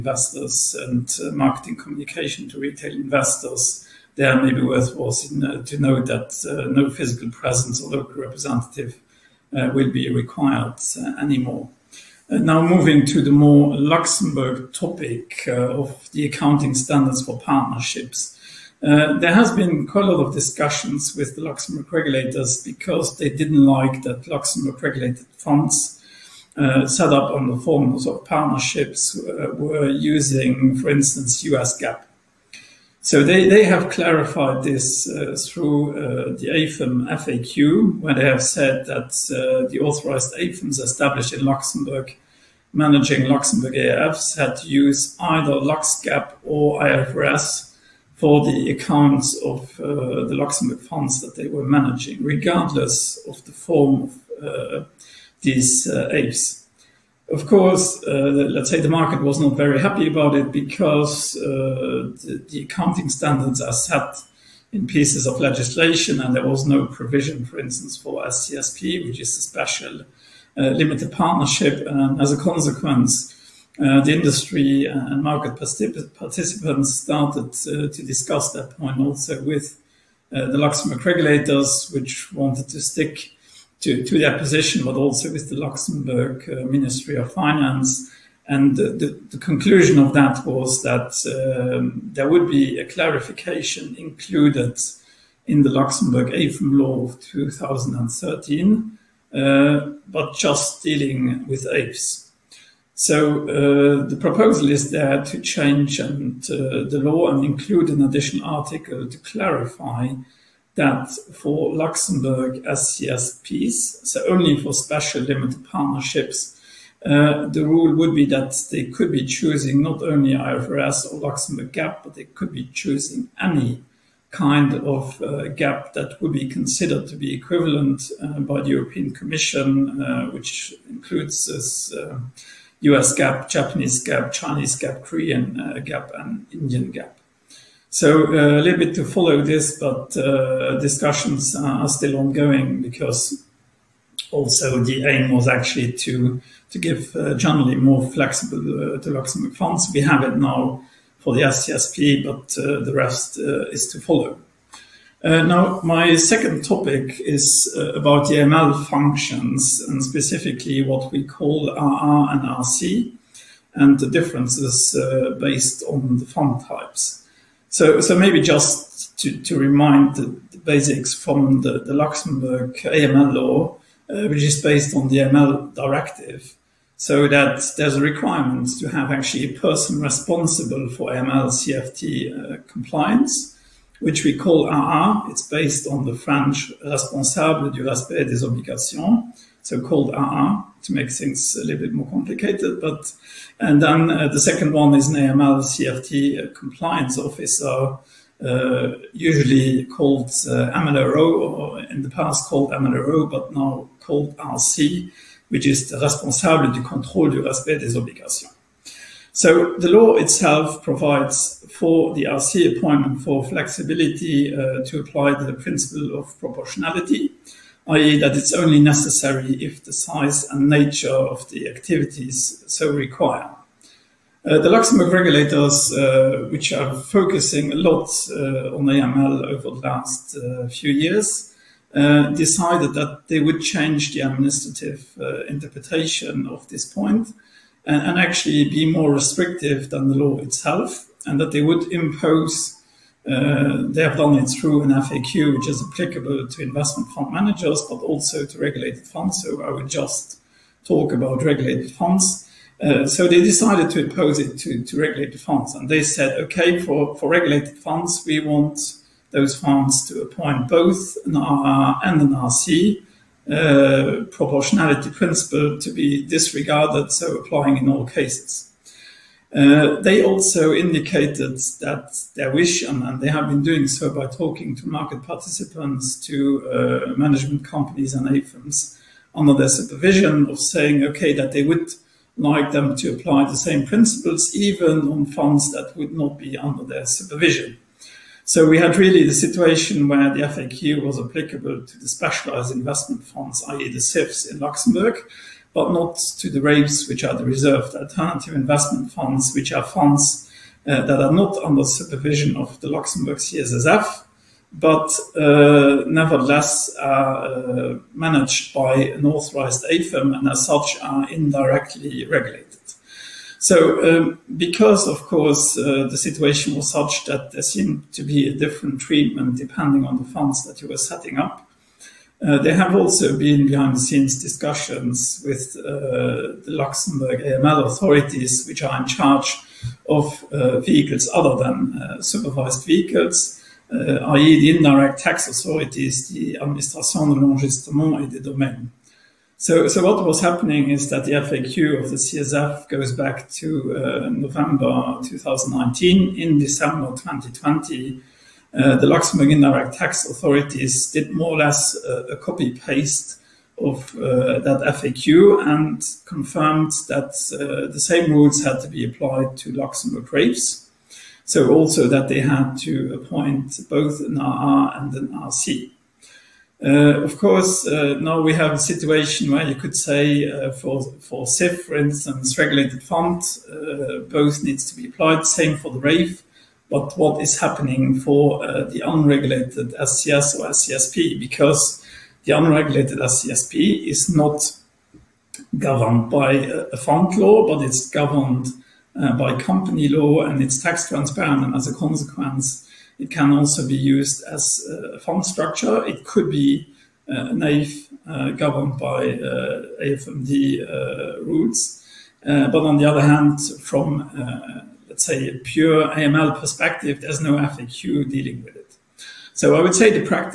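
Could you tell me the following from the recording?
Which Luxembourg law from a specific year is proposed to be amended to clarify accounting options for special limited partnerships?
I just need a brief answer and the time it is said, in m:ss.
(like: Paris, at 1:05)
AIFM law of 2013, at 1:36.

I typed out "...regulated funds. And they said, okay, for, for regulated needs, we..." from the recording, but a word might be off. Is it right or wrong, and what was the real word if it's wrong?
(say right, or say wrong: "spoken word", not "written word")
wrong: "funds", not "needs".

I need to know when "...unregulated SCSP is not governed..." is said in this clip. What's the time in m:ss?
6:22.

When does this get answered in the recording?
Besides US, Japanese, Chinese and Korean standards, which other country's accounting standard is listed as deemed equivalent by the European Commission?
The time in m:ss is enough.
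2:16.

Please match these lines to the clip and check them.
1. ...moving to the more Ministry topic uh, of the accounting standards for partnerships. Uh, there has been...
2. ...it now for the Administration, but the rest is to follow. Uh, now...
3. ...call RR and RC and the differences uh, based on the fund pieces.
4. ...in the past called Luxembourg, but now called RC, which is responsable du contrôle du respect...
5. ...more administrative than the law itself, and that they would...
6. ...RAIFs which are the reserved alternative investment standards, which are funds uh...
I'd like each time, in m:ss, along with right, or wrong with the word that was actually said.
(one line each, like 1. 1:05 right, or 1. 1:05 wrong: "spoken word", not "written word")
1. 0:12 wrong: "Luxembourg", not "Ministry"
2. 2:30 wrong: "SCSP", not "Administration"
3. 2:41 wrong: "types", not "pieces"
4. 3:21 wrong: "MLRO", not "Luxembourg"
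5. 3:58 wrong: "restrictive", not "administrative"
6. 4:56 wrong: "funds", not "standards".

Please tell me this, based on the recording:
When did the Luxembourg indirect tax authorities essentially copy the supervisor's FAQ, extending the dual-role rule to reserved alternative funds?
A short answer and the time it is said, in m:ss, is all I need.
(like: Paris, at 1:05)
December 2020, at 5:46.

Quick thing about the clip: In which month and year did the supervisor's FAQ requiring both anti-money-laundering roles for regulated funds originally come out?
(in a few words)
November 2019.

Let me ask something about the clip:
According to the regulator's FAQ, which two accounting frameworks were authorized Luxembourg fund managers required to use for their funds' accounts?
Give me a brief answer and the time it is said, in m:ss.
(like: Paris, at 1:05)
Lux GAAP or IFRS, at 0:45.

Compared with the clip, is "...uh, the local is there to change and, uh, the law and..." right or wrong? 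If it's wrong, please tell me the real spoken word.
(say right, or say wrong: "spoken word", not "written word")
wrong: "proposal", not "local".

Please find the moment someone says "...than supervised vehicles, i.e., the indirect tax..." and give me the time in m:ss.
5:31.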